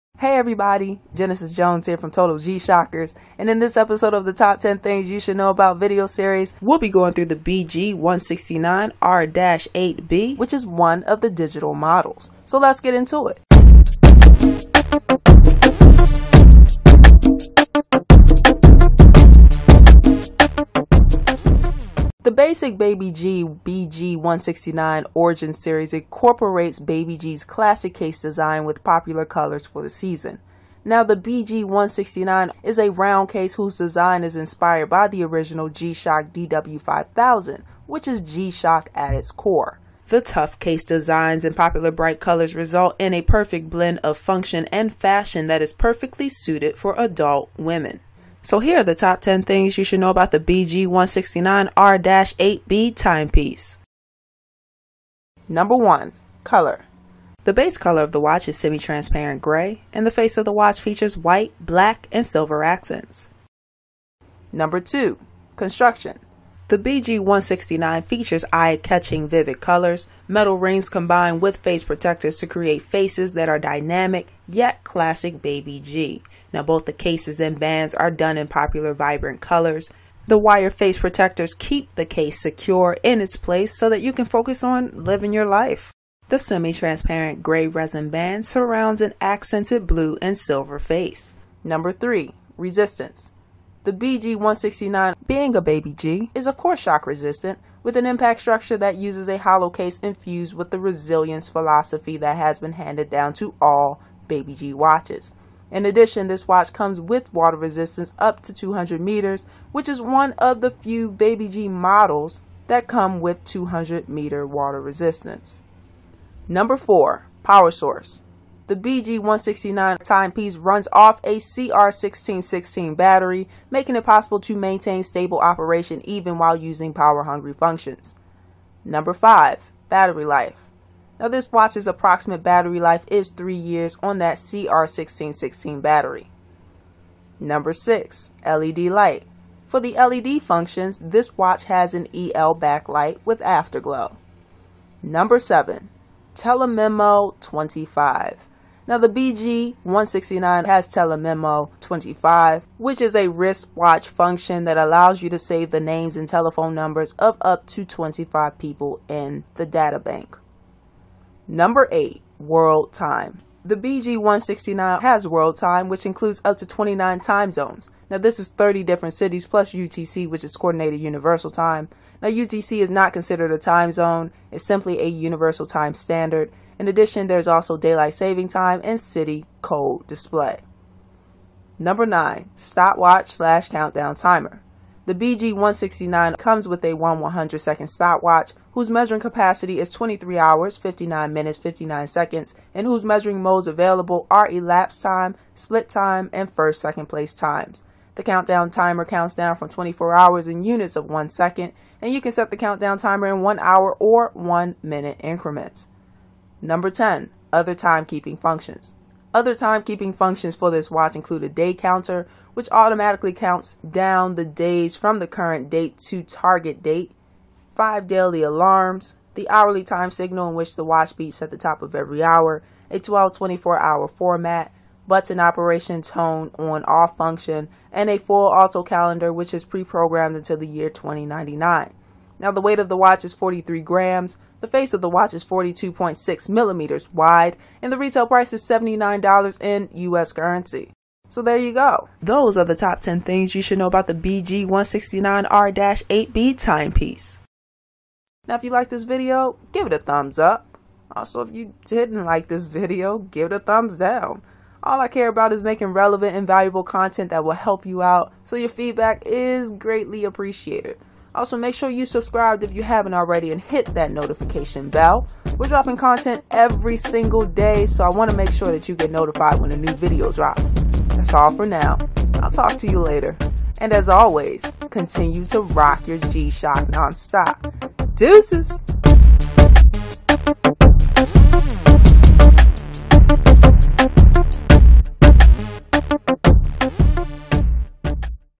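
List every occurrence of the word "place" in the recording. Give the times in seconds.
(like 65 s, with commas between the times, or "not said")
83 s, 197 s.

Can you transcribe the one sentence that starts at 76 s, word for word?
Now both the cases and bands are done in popular vibrant colors.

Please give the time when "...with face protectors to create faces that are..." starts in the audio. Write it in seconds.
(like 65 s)
71 s.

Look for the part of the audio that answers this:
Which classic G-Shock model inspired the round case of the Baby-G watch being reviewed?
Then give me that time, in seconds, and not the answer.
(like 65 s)
36 s.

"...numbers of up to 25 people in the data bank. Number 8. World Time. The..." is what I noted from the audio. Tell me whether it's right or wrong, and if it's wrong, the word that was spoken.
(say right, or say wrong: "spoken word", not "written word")
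right.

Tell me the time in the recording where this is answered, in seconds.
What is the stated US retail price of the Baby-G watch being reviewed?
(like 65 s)
238 s.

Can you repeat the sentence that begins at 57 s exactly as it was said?
The base color of the watch is semi-transparent gray, and the face of the watch features white, black, and silver accents.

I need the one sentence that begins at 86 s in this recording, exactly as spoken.
The semi-transparent gray resin band surrounds an accented blue and silver face.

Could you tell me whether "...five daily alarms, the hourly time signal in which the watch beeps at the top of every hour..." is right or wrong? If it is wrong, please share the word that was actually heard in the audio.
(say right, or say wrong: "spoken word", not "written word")
right.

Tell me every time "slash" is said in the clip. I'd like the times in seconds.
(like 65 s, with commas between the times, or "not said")
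183 s.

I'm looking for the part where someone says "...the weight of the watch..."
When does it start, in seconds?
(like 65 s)
232 s.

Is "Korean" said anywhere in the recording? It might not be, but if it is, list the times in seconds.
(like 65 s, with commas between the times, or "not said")
not said.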